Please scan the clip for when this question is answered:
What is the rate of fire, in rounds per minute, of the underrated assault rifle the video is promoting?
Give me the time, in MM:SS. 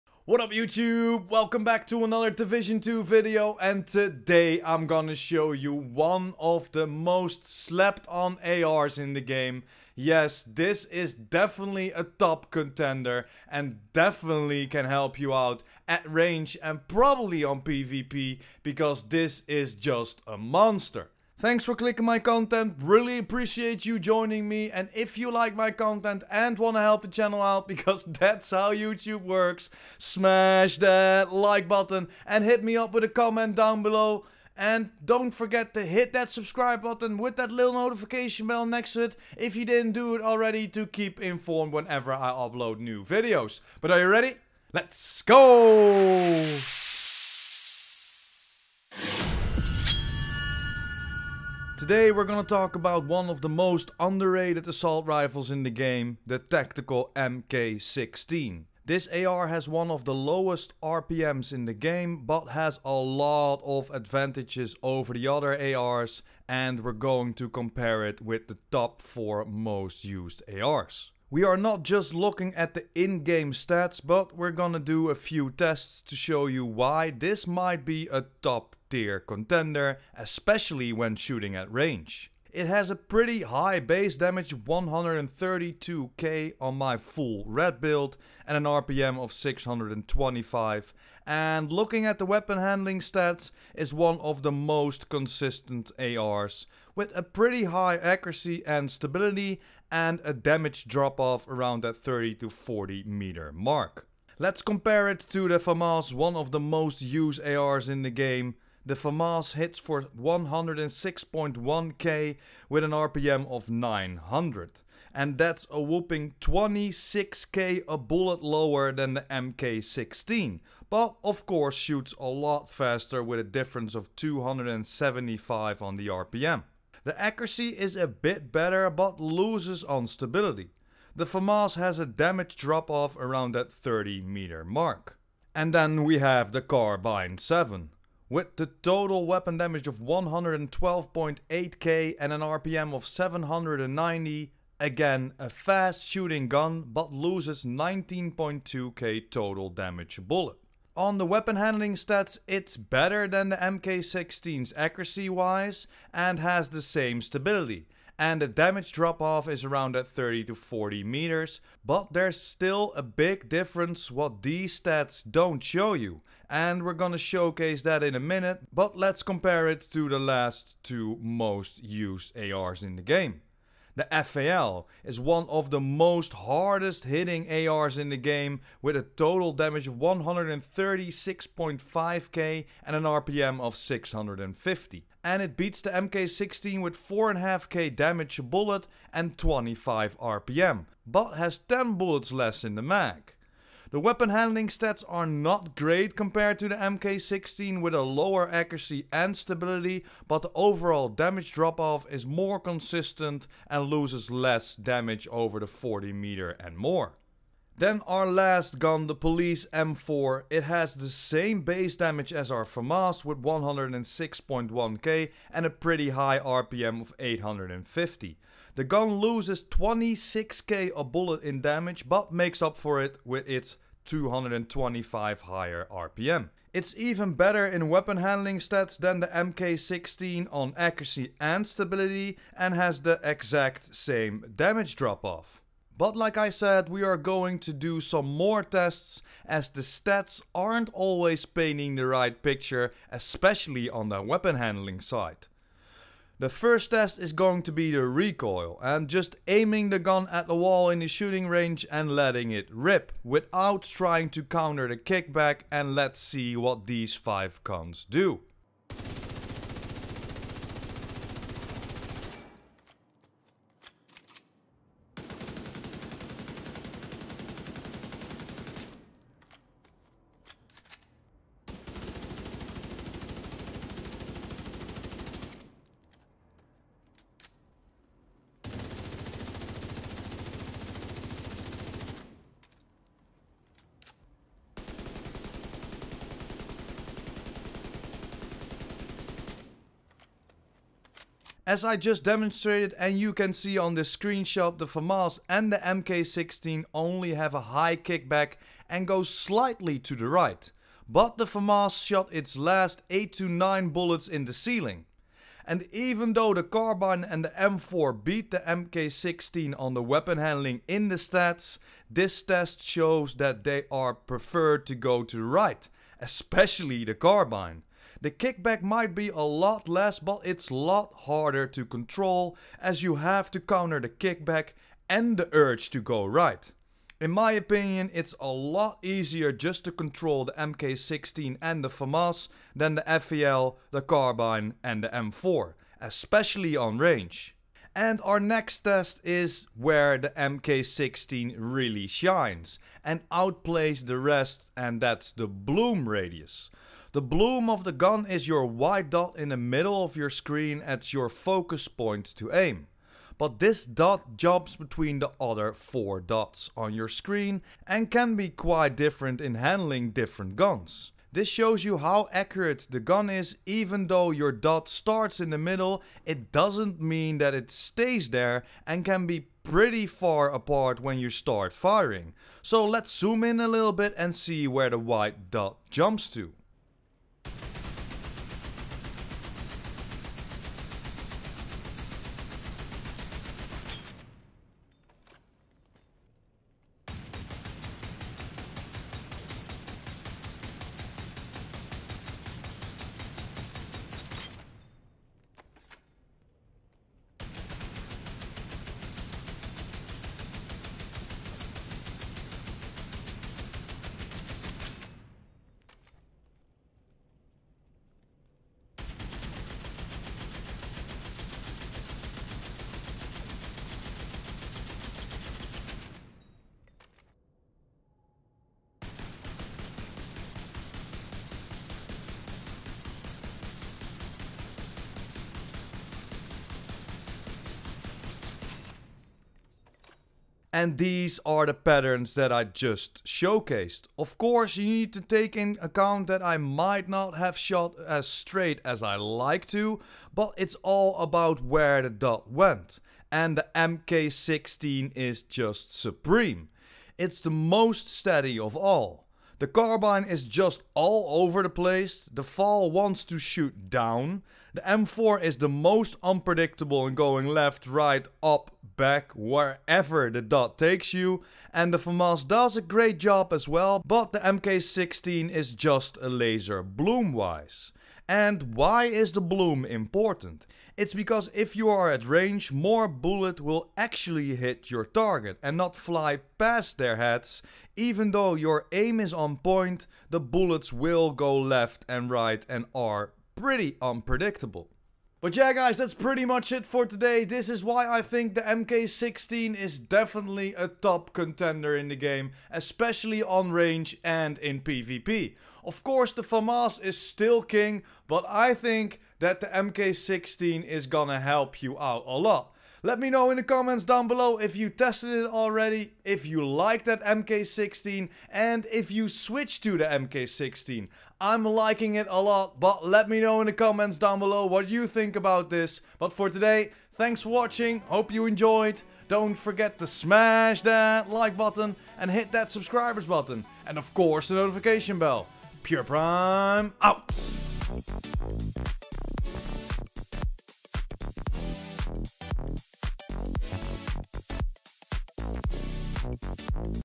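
01:29.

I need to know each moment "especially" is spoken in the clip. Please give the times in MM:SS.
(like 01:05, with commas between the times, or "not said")
01:20, 04:03, 05:16, 05:35, 08:12.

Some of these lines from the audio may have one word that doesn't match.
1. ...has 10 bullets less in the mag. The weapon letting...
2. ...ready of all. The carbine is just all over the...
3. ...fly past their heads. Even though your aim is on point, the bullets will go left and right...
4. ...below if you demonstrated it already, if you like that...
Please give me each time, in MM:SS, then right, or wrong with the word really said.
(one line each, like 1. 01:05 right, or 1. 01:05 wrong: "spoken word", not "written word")
1. 03:11 wrong: "handling", not "letting"
2. 07:28 wrong: "steady", not "ready"
3. 07:55 right
4. 08:24 wrong: "tested", not "demonstrated".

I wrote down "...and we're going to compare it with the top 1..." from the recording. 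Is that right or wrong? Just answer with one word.
wrong.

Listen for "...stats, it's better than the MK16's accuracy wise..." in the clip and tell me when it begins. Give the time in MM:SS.
02:31.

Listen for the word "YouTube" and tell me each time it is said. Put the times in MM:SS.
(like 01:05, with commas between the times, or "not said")
00:00, 00:28.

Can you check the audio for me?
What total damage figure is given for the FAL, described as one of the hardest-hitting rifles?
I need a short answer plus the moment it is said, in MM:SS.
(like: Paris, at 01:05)
136.5k, at 02:59.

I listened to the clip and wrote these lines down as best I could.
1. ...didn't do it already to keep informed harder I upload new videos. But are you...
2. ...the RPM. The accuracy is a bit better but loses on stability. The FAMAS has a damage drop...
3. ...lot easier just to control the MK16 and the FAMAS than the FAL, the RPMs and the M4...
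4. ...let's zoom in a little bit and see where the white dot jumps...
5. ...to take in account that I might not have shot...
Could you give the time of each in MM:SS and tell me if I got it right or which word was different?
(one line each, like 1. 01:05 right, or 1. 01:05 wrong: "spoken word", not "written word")
1. 00:39 wrong: "whenever", not "harder"
2. 02:05 right
3. 05:28 wrong: "Carbine", not "RPMs"
4. 06:12 right
5. 07:15 right.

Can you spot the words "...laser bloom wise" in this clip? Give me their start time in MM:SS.
07:46.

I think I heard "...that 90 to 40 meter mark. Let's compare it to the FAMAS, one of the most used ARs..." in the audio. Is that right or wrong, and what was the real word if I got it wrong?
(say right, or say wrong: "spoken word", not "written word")
wrong: "30", not "90".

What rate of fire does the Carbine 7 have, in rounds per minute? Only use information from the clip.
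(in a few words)
790.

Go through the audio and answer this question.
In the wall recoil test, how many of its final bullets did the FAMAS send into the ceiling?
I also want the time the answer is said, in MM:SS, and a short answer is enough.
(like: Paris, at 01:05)
8 to 9, at 05:03.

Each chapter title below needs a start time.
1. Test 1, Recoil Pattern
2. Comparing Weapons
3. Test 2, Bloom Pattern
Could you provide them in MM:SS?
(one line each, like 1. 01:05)
1. 04:07
2. 00:51
3. 05:38.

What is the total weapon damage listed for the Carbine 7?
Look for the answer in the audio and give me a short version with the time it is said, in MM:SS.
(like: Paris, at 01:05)
112.8k, at 02:19.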